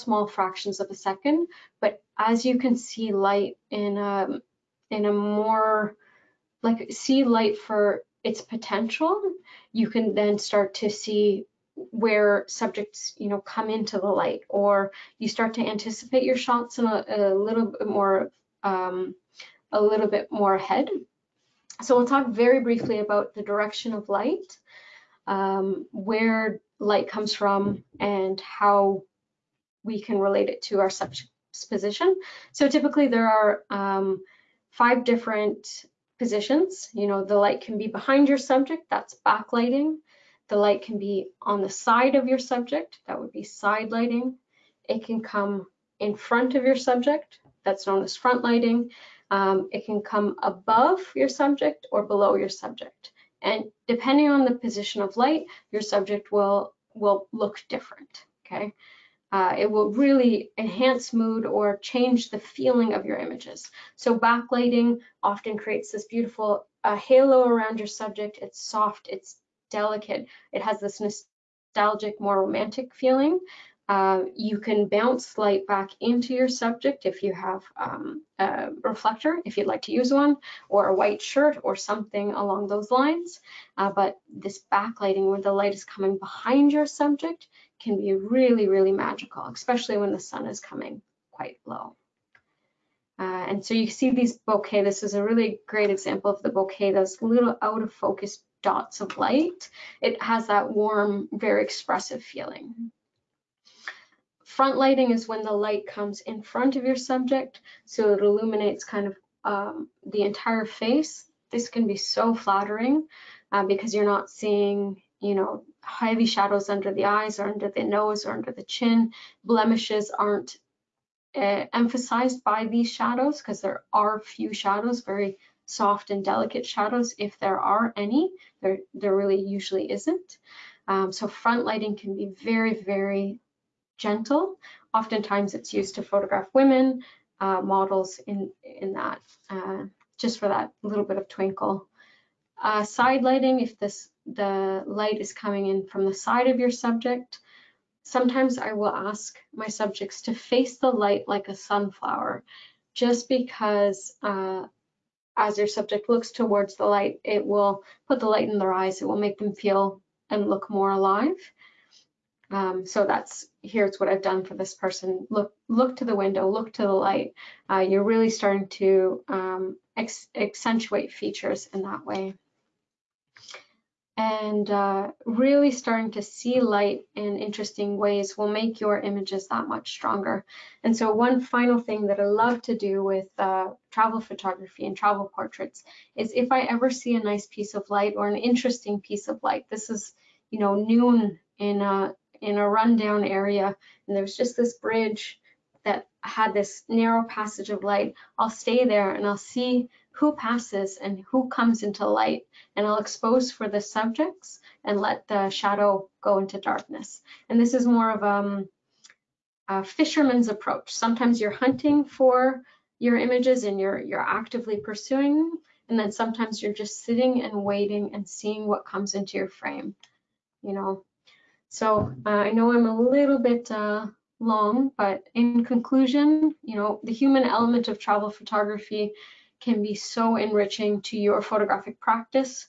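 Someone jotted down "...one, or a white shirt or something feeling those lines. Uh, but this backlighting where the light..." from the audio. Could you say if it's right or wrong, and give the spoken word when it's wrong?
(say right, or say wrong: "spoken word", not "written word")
wrong: "along", not "feeling".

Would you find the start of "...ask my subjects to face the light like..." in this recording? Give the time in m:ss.
2:28.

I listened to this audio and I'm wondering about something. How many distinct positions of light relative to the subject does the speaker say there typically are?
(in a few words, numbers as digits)
5.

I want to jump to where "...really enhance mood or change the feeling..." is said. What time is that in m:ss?
0:59.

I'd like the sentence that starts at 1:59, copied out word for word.
Blemishes aren't uh, emphasized by these shadows because there are few shadows, very soft and delicate shadows.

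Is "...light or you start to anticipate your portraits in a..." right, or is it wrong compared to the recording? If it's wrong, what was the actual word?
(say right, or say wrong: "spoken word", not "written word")
wrong: "shots", not "portraits".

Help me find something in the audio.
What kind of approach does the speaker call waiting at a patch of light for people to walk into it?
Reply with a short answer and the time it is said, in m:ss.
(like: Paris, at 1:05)
A fisherman's approach, at 3:29.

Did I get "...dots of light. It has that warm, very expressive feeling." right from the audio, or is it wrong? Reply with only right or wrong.
right.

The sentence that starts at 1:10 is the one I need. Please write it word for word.
It has this nostalgic, more romantic feeling.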